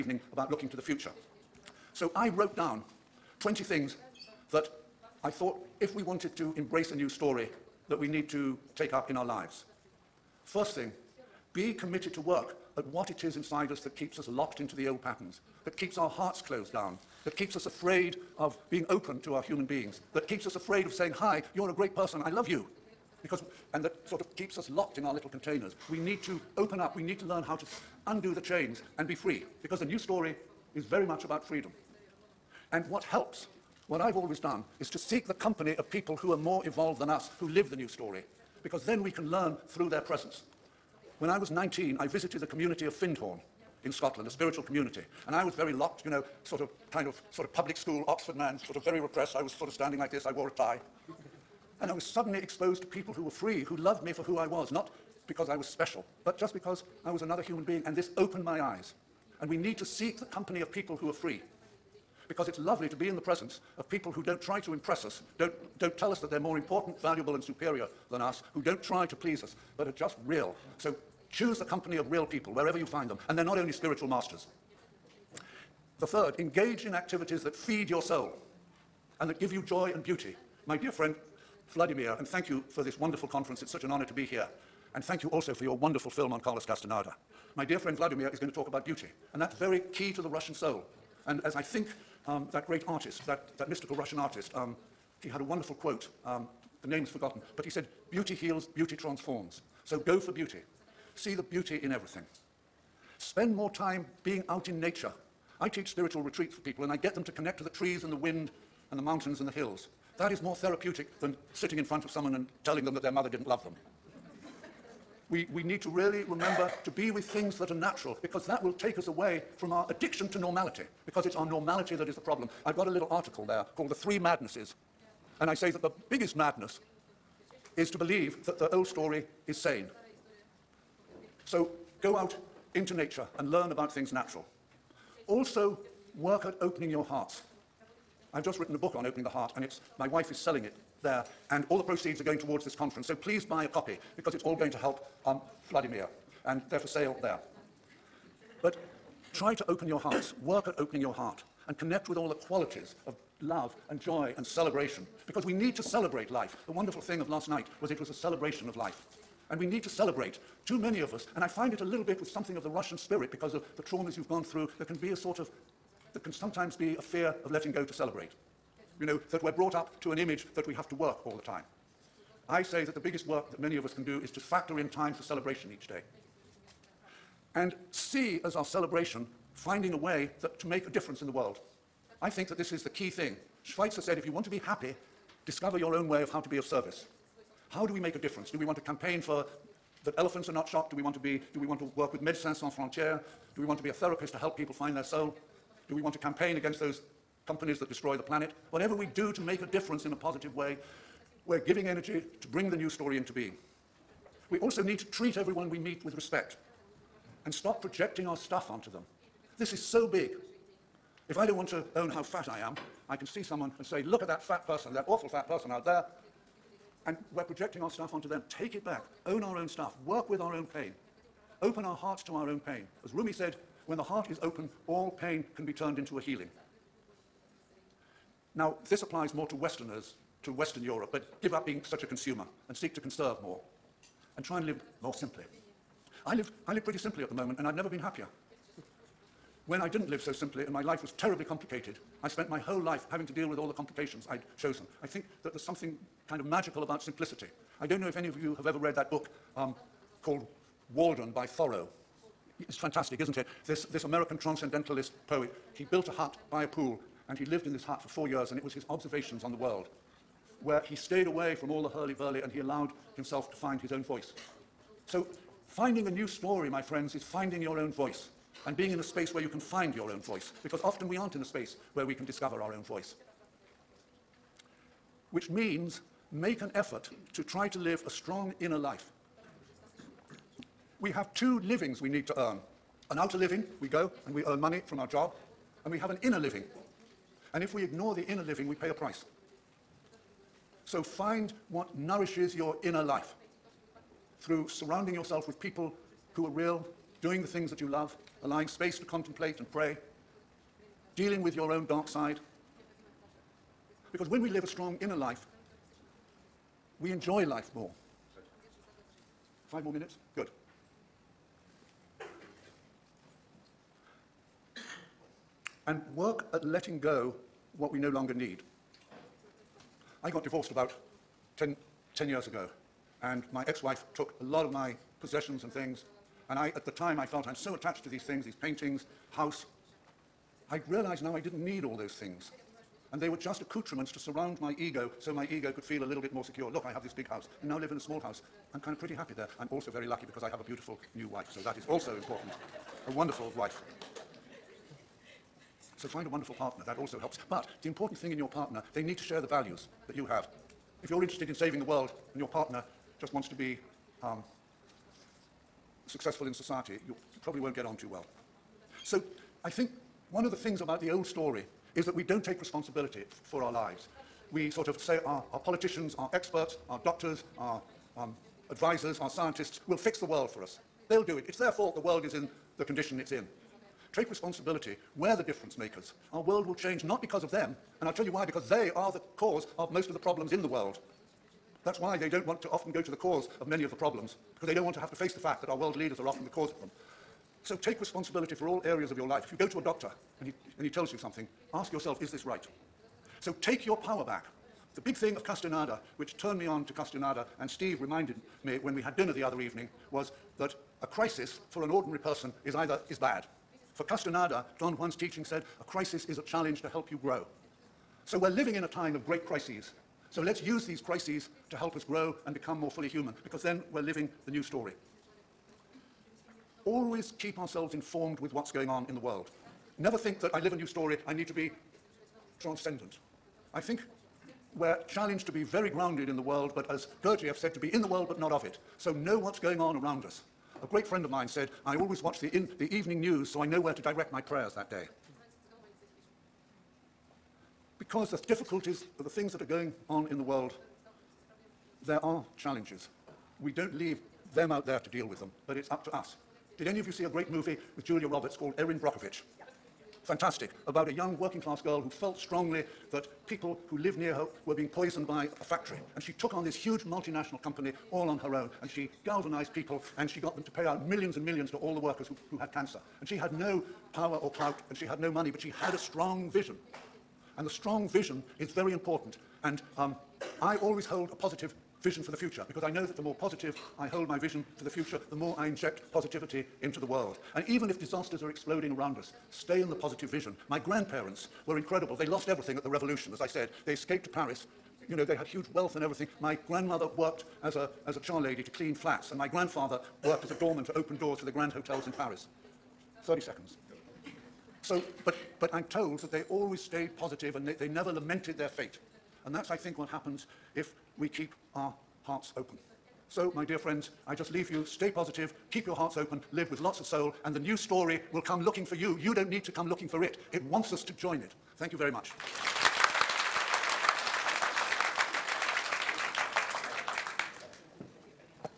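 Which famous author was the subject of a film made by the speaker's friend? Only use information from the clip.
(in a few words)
Carlos Castaneda.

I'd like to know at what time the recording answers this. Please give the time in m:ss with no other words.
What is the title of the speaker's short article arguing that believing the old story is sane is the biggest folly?
2:03.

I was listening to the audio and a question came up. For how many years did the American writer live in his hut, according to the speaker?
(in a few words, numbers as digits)
4.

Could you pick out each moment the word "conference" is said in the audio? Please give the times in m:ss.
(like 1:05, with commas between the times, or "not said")
1:23, 2:22.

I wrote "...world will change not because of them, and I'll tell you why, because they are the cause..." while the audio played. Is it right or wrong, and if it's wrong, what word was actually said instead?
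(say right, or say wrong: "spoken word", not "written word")
right.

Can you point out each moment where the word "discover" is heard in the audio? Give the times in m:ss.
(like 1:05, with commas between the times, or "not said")
3:05, 4:32.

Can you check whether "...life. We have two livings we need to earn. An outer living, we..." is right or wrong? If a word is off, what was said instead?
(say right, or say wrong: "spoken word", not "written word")
right.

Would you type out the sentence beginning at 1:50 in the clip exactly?
That is more therapeutic than sitting in front of someone and telling them that their mother didn't love them.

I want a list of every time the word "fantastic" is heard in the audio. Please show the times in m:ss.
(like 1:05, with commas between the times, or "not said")
4:12, 7:30.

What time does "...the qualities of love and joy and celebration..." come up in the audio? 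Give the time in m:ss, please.
2:32.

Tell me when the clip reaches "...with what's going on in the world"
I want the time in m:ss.
6:58.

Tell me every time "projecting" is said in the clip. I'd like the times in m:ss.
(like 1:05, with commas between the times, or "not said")
3:27, 3:37.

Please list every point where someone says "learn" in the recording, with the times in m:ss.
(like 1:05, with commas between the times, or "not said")
0:27, 0:39, 2:13.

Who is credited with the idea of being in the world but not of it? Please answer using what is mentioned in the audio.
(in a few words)
Gurdjieff.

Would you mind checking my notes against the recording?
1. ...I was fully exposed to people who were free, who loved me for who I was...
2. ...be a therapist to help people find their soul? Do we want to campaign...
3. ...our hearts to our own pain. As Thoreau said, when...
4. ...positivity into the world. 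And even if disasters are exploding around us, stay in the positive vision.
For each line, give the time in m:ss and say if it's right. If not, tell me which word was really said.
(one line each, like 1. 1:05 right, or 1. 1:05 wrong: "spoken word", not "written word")
1. 0:51 wrong: "suddenly", not "fully"
2. 3:13 right
3. 3:41 wrong: "Rumi", not "Thoreau"
4. 7:56 right.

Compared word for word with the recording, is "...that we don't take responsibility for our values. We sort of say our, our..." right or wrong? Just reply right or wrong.
wrong.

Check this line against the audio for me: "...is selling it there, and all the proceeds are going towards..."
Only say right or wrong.
right.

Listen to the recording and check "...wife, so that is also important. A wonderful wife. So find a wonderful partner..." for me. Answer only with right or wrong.
right.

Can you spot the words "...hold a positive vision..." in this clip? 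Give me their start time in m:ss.
7:51.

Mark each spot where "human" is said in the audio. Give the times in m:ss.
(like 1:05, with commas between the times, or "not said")
0:19, 0:57, 6:53.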